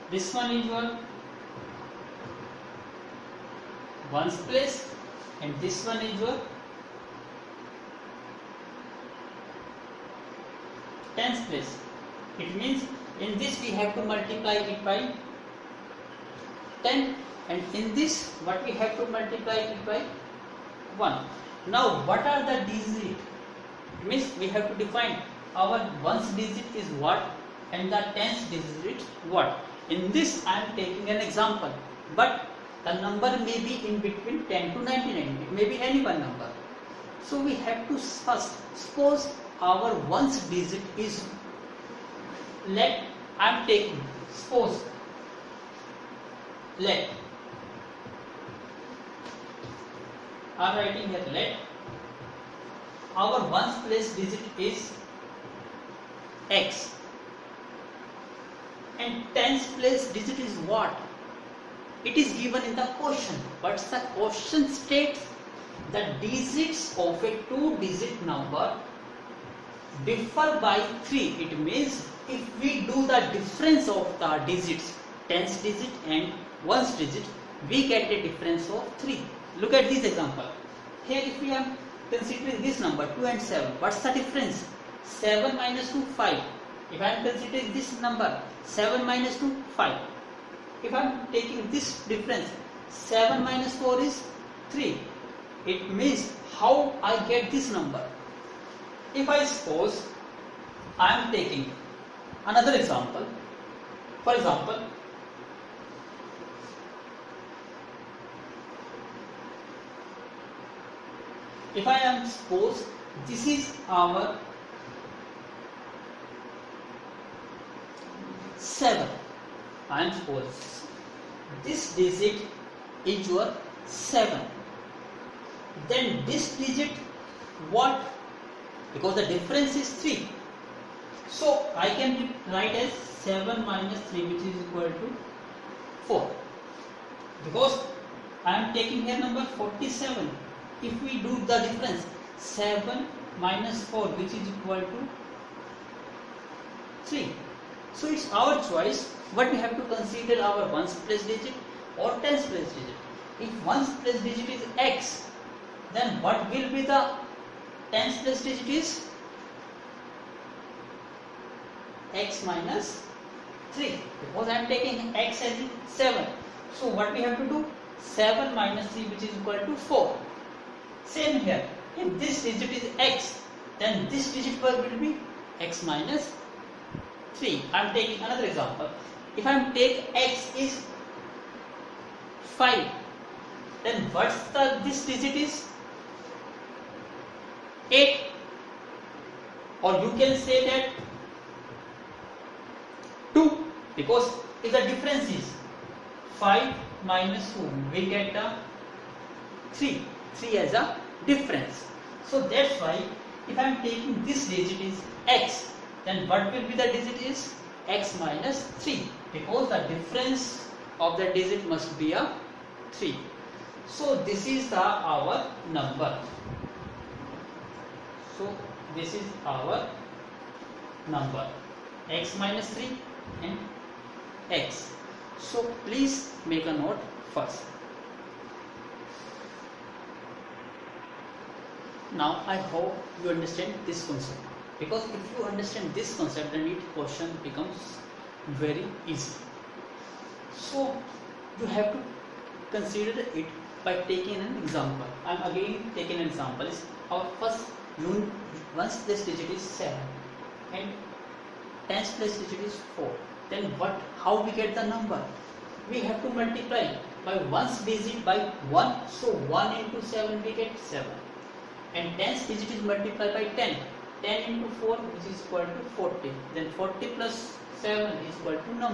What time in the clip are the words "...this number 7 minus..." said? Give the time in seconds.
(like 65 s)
87 s.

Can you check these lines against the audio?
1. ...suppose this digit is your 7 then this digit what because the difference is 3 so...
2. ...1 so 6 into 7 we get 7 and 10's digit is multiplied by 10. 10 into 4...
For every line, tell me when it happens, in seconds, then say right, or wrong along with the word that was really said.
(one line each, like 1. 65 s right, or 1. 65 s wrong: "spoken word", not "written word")
1. 120 s right
2. 258 s wrong: "1", not "6".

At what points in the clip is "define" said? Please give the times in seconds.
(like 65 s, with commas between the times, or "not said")
24 s.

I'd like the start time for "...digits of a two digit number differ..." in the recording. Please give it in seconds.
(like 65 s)
66 s.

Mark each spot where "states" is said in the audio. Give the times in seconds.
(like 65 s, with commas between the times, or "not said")
64 s.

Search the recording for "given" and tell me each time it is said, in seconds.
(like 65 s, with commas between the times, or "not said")
62 s.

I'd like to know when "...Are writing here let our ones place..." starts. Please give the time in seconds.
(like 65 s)
50 s.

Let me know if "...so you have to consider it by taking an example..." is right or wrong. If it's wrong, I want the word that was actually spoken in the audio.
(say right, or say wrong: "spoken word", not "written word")
right.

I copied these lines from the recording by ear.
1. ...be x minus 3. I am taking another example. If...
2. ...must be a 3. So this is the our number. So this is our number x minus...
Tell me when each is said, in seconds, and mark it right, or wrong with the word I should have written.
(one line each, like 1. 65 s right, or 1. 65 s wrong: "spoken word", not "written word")
1. 174 s right
2. 211 s right.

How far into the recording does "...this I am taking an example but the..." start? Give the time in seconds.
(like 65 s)
30 s.